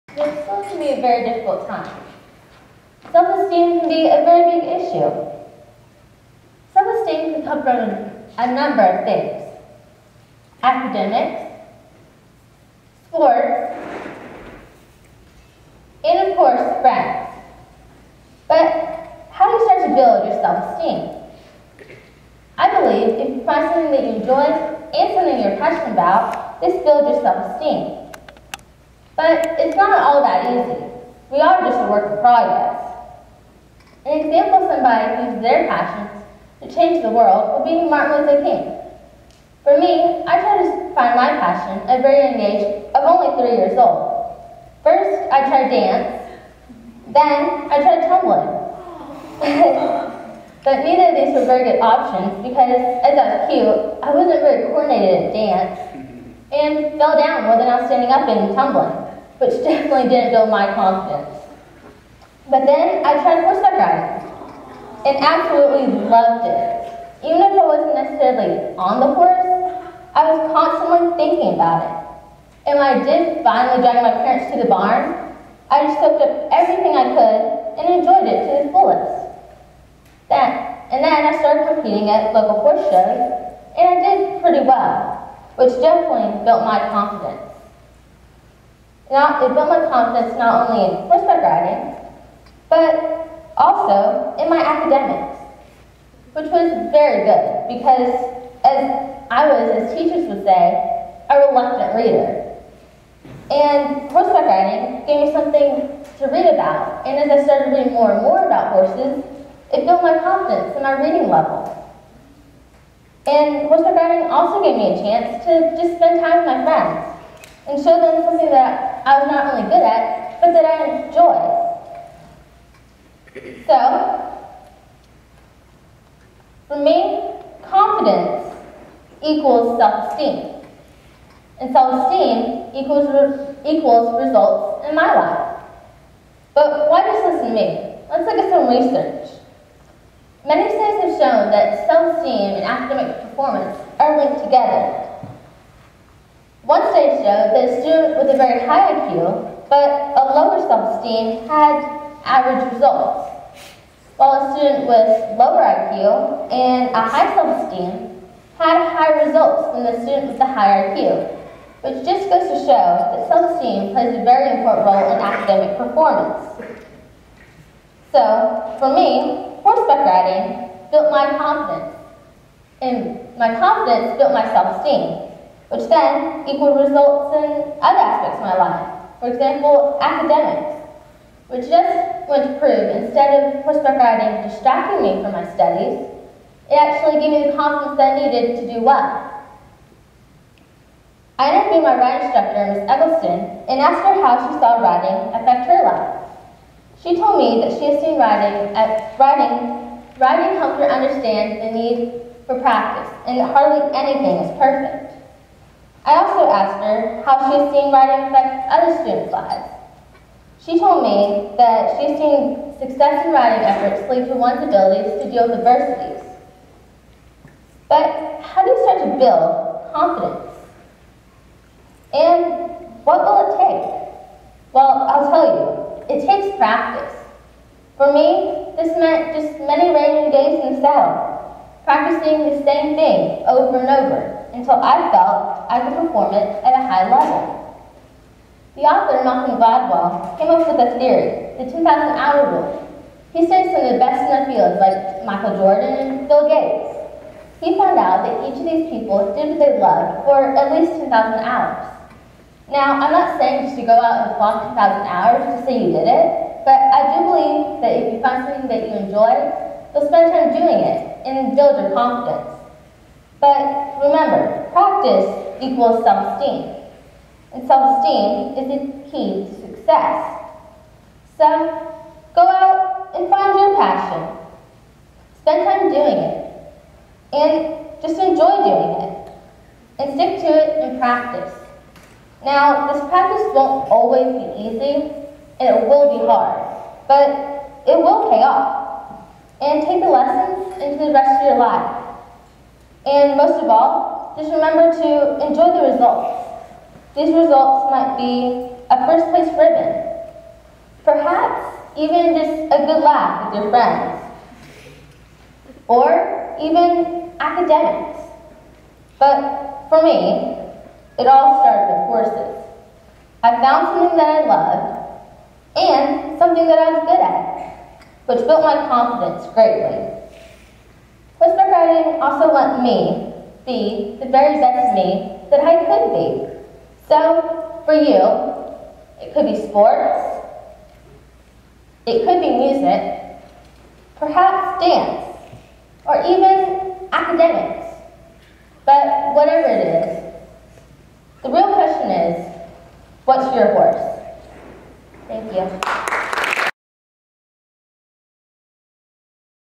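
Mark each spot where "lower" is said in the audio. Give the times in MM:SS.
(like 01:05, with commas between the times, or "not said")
02:30, 02:35.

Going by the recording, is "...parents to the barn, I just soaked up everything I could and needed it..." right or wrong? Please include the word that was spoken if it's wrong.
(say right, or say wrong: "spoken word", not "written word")
wrong: "enjoyed", not "needed".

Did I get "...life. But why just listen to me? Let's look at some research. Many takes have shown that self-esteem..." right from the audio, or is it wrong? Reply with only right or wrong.
wrong.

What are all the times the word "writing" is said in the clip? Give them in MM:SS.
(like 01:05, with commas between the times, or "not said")
03:11, 03:27, 03:33, 05:21.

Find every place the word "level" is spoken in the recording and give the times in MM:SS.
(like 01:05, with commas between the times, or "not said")
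01:51, 03:57.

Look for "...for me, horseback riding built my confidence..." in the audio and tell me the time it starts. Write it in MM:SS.
02:48.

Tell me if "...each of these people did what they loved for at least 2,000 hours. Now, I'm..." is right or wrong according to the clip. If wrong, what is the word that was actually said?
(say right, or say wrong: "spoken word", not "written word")
right.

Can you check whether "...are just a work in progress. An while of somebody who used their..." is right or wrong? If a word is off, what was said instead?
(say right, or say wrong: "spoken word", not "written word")
wrong: "example", not "while".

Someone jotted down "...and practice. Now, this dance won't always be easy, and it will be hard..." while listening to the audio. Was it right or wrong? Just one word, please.
wrong.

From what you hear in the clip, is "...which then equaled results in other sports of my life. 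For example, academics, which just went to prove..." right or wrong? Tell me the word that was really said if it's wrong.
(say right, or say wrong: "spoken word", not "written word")
wrong: "aspects", not "sports".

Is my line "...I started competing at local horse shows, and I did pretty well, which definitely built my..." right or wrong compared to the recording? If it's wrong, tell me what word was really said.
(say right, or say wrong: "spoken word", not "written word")
right.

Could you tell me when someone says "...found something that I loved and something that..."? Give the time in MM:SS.
05:13.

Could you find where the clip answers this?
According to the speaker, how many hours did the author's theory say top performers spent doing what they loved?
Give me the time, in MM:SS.
04:01.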